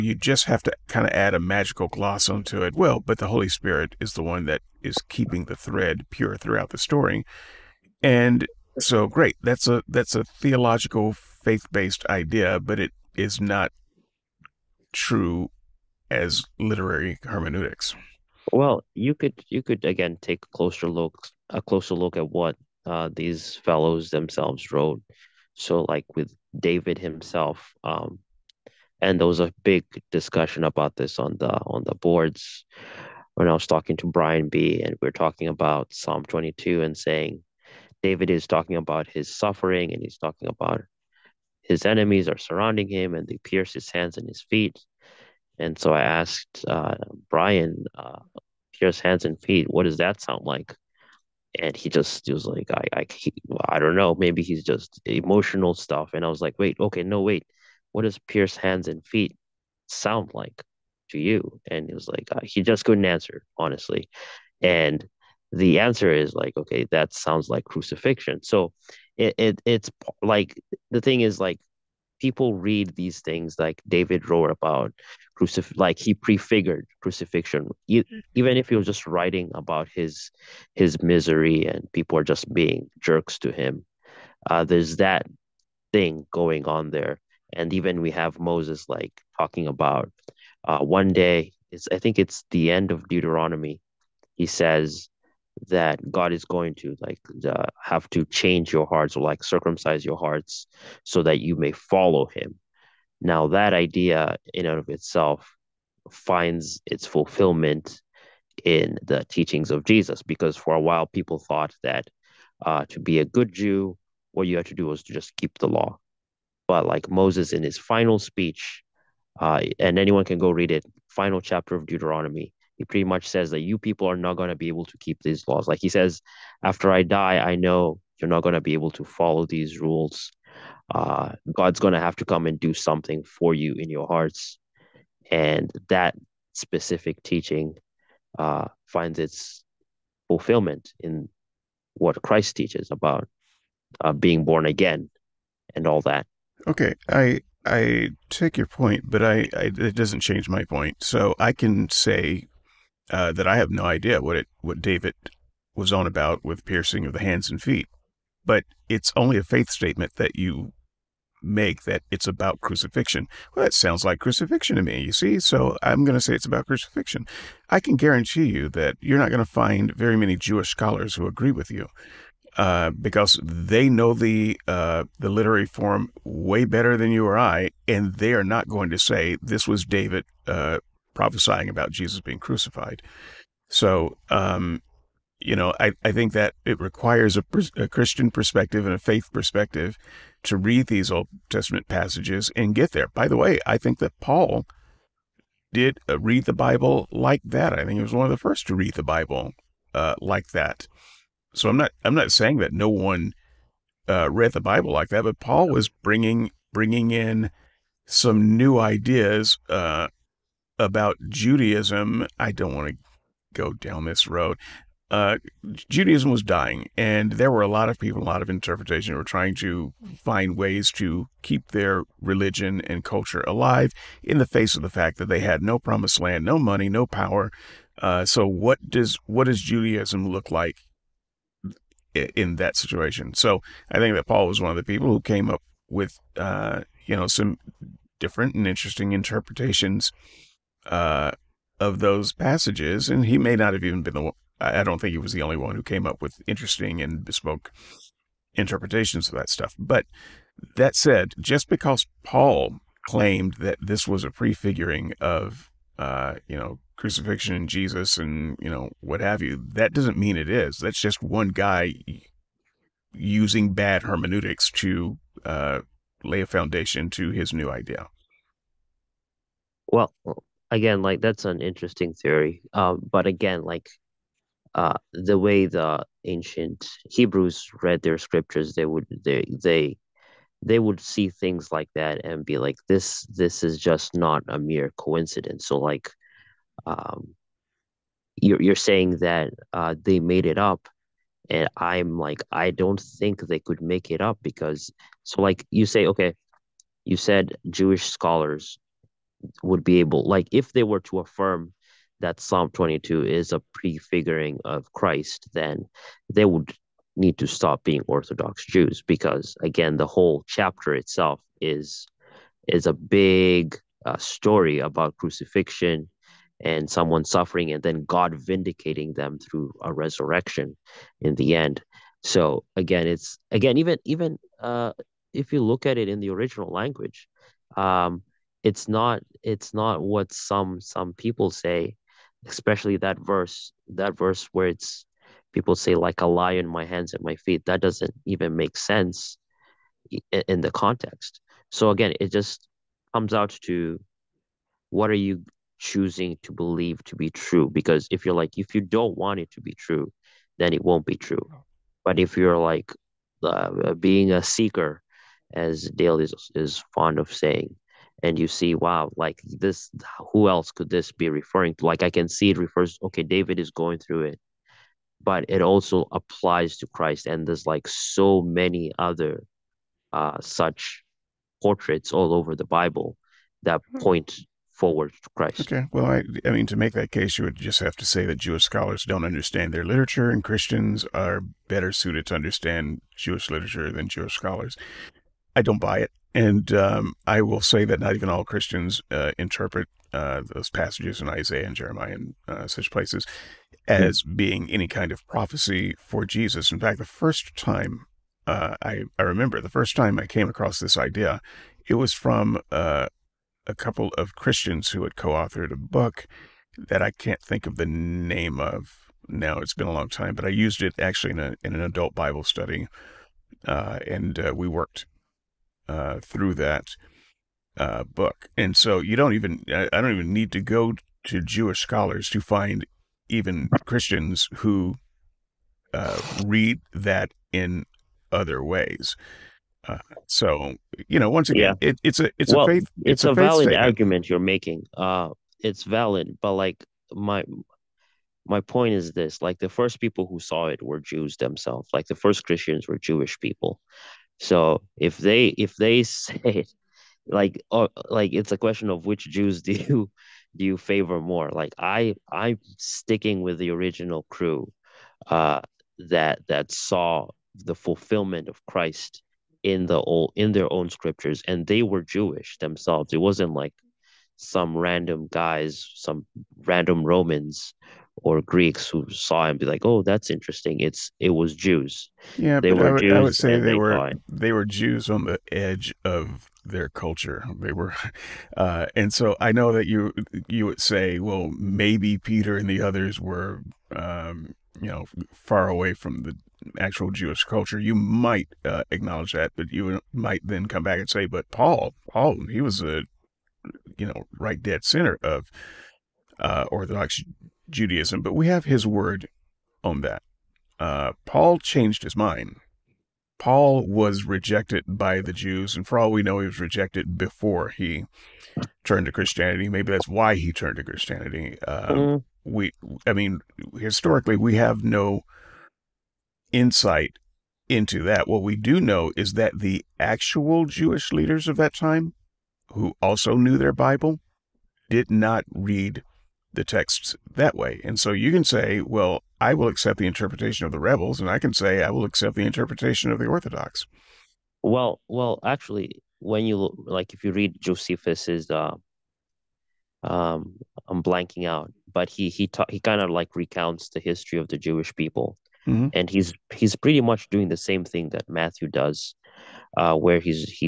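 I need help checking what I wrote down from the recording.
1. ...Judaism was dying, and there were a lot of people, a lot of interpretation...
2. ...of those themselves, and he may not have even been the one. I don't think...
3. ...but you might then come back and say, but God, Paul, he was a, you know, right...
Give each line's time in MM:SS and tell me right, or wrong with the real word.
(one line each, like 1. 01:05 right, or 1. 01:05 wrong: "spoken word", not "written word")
1. 03:35 right
2. 04:01 wrong: "passages", not "themselves"
3. 08:09 wrong: "Paul", not "God".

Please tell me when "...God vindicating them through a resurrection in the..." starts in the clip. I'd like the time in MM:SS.
05:18.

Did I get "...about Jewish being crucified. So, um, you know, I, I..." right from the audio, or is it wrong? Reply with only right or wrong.
wrong.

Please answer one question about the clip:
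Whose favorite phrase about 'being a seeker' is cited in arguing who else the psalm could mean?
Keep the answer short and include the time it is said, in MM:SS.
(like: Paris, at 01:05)
Dale, at 05:55.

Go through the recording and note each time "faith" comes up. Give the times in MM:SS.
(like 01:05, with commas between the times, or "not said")
00:11, 02:39, 03:08, 07:12.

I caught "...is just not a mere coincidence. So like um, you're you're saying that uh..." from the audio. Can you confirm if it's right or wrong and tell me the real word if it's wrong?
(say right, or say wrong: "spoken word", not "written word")
right.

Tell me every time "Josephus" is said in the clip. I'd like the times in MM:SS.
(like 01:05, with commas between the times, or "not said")
08:57.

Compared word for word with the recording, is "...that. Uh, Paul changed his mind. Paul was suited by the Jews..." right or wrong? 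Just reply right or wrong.
wrong.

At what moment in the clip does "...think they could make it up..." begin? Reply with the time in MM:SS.
04:52.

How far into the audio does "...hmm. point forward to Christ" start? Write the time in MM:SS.
06:13.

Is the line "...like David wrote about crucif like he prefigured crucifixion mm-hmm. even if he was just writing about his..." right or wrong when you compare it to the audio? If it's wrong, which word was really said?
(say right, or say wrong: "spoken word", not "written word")
right.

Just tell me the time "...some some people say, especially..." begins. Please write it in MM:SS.
05:30.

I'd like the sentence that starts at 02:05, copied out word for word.
Like he says, after I die, I know you're not going to be able to follow these rules.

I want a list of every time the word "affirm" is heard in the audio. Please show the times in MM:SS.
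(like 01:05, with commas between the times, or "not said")
05:01.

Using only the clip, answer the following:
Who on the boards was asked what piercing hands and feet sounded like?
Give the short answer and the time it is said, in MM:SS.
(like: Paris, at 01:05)
Brian B, at 00:34.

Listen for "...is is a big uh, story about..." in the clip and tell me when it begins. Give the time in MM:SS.
05:11.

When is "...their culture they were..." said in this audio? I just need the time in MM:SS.
07:56.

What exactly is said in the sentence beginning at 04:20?
That's just one guy using bad hermeneutics to uh, lay a foundation to his new idea.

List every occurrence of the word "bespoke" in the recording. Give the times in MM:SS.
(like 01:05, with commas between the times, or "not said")
04:07.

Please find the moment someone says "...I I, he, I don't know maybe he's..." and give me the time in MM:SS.
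00:52.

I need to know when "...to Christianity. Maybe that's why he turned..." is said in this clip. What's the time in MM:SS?
08:29.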